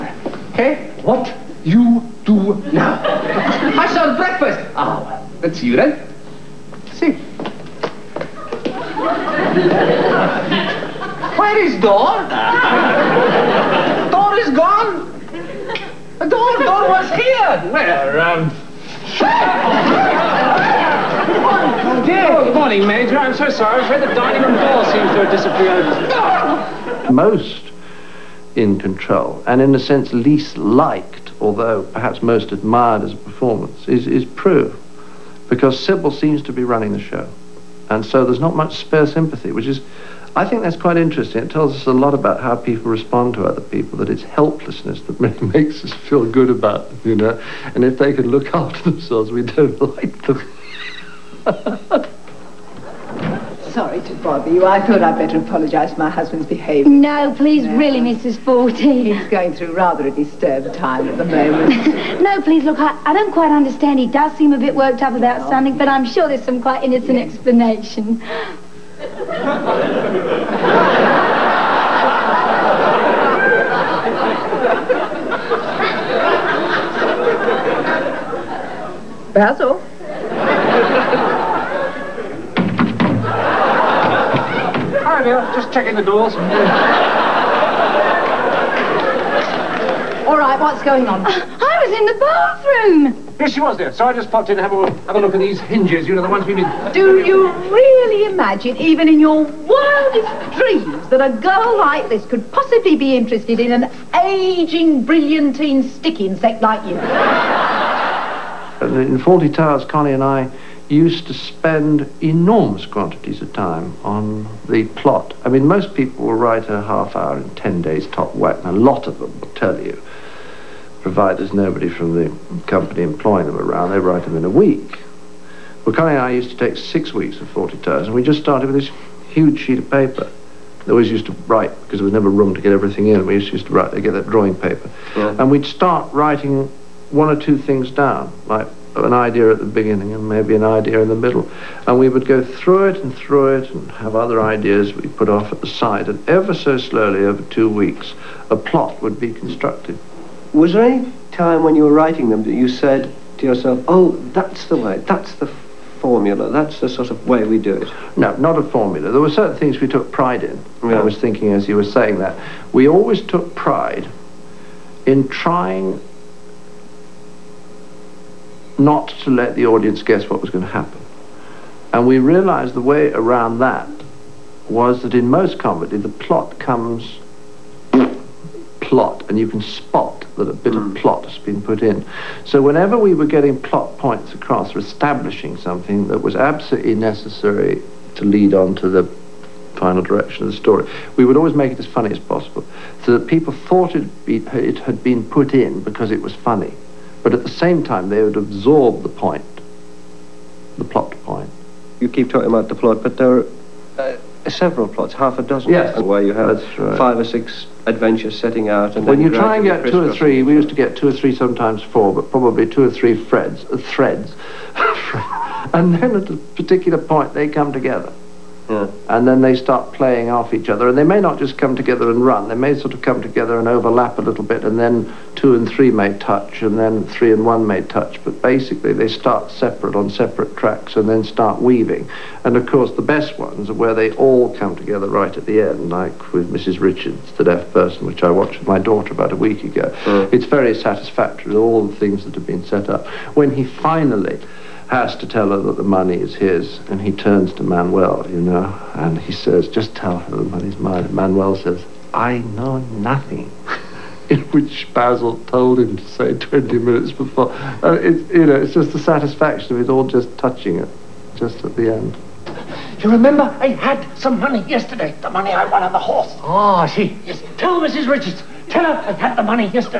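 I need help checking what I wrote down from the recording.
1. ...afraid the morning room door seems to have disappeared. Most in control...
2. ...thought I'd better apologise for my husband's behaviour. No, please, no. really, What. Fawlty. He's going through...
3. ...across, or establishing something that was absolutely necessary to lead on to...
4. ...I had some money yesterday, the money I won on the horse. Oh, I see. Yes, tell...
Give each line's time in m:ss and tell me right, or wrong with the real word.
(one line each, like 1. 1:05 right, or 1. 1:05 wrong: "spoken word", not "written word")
1. 0:23 wrong: "dining", not "morning"
2. 0:54 wrong: "Mrs", not "What"
3. 3:04 right
4. 4:23 right.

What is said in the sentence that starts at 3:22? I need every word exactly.
You keep talking about the plot, but there.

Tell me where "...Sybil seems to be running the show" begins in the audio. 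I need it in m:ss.
0:35.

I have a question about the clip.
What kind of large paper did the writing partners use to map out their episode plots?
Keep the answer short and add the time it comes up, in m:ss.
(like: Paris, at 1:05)
Drawing paper, at 2:14.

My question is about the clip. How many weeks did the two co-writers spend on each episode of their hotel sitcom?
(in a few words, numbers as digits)
6 weeks.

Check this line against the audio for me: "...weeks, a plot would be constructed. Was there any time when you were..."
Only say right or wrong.
right.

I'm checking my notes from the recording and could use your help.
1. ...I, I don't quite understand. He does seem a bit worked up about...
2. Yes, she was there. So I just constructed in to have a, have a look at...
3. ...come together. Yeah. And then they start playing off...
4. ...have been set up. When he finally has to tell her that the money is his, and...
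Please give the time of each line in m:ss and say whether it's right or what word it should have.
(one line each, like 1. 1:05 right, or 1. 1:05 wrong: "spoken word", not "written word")
1. 1:02 right
2. 1:33 wrong: "popped", not "constructed"
3. 3:37 right
4. 4:02 right.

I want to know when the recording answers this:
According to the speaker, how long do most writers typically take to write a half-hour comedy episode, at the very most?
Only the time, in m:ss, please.
1:57.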